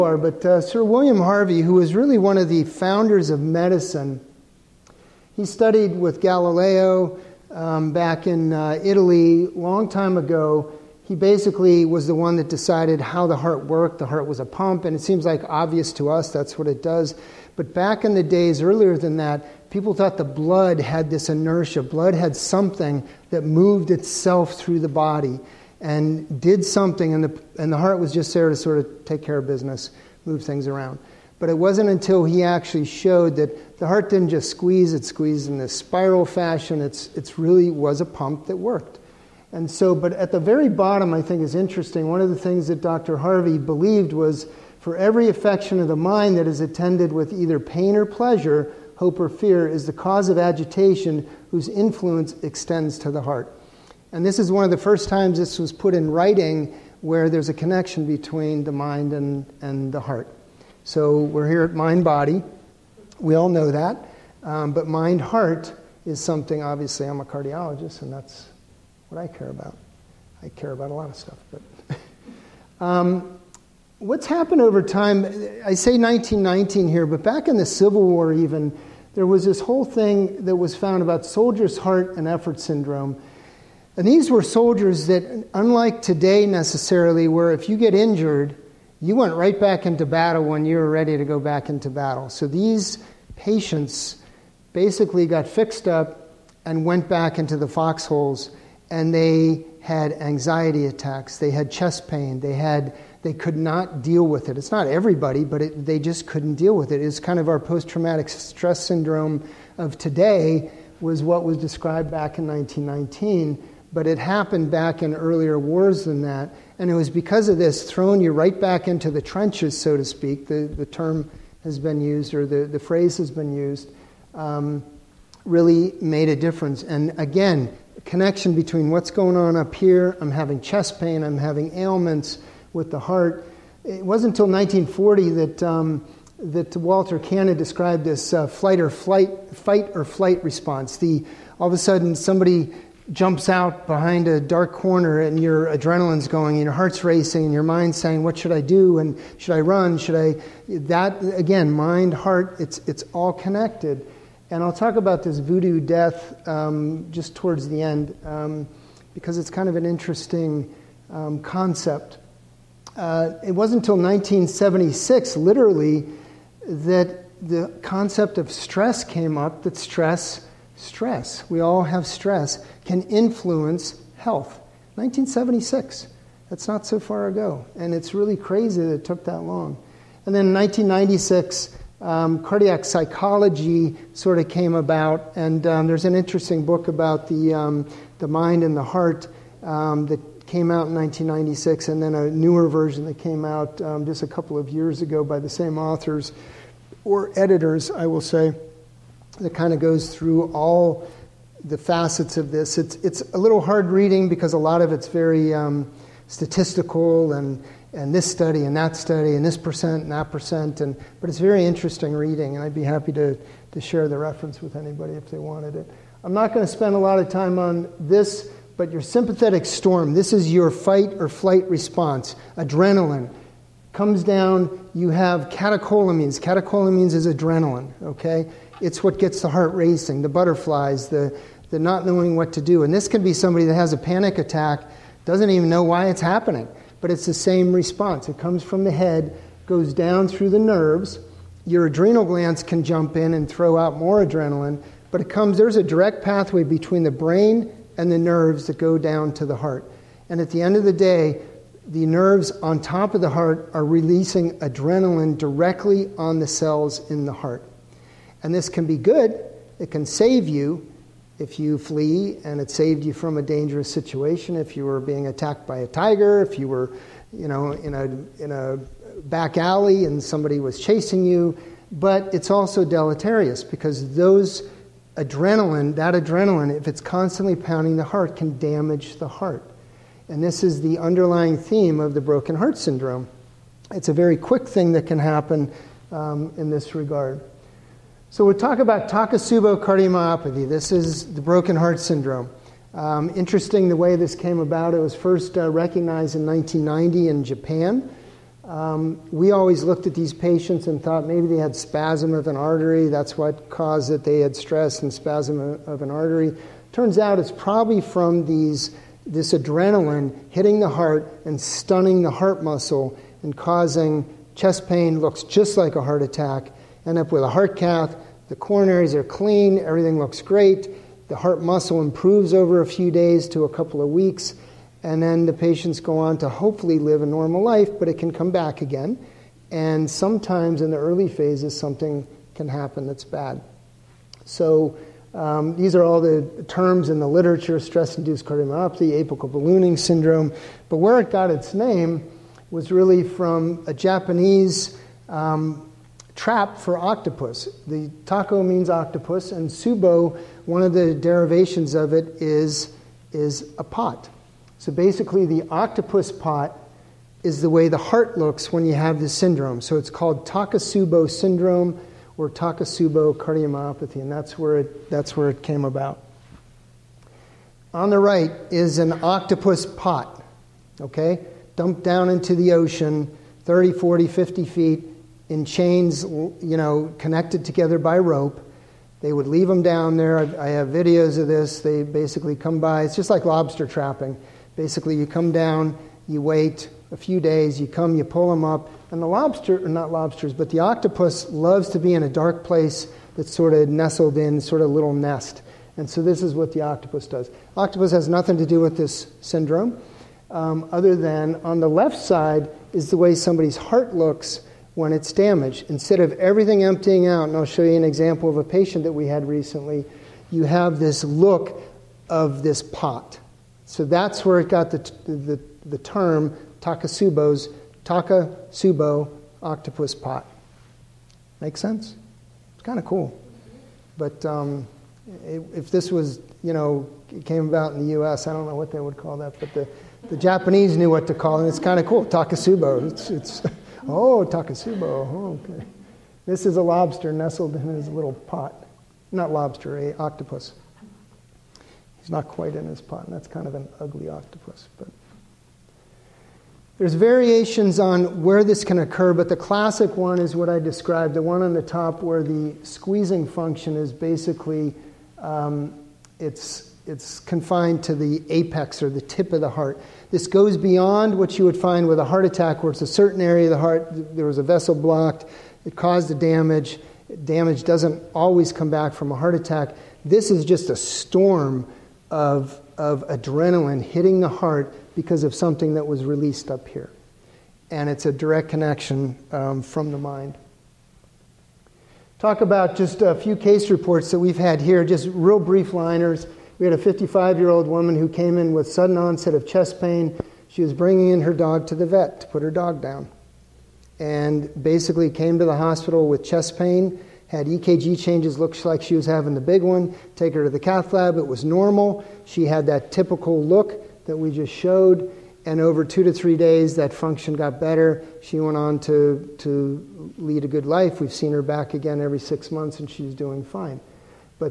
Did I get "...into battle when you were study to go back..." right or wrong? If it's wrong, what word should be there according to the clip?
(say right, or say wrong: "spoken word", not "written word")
wrong: "ready", not "study".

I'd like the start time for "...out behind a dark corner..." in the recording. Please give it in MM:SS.
02:23.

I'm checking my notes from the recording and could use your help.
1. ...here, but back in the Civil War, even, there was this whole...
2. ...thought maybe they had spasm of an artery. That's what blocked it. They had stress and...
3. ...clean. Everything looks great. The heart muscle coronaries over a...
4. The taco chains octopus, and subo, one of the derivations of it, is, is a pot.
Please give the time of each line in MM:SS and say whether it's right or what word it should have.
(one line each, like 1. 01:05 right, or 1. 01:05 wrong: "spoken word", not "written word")
1. 01:16 right
2. 05:01 wrong: "caused", not "blocked"
3. 05:19 wrong: "improves", not "coronaries"
4. 05:47 wrong: "means", not "chains".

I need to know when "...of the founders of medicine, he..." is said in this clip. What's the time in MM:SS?
00:02.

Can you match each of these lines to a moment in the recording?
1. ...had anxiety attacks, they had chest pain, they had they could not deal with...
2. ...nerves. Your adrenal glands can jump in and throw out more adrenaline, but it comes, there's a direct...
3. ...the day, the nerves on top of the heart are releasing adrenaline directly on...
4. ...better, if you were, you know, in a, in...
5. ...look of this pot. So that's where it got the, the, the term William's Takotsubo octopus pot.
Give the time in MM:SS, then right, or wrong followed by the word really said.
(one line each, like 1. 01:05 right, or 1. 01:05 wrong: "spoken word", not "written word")
1. 01:39 right
2. 04:00 right
3. 04:10 right
4. 04:25 wrong: "tiger", not "better"
5. 06:51 wrong: "Takotsubo", not "William".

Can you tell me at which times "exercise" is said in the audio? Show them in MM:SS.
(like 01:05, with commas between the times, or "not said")
not said.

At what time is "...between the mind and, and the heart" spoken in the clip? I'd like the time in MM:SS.
00:58.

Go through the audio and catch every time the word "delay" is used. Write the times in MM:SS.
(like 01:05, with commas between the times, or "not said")
not said.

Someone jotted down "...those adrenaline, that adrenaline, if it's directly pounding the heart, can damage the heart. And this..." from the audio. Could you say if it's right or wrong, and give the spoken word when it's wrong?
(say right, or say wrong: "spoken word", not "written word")
wrong: "constantly", not "directly".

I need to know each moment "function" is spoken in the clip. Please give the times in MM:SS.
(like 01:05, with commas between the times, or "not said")
07:33, 08:27.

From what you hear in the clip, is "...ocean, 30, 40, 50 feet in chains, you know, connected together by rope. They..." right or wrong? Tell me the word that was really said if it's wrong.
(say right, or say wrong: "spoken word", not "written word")
right.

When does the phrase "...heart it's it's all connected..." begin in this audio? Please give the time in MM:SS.
02:32.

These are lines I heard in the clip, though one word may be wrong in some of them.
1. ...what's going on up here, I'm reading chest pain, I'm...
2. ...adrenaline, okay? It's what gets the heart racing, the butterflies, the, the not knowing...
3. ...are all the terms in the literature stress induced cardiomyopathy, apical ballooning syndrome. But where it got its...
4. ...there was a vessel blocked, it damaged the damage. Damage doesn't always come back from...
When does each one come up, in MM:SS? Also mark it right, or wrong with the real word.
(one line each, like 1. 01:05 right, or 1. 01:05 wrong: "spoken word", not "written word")
1. 02:08 wrong: "having", not "reading"
2. 03:47 right
3. 05:35 right
4. 07:44 wrong: "caused", not "damaged".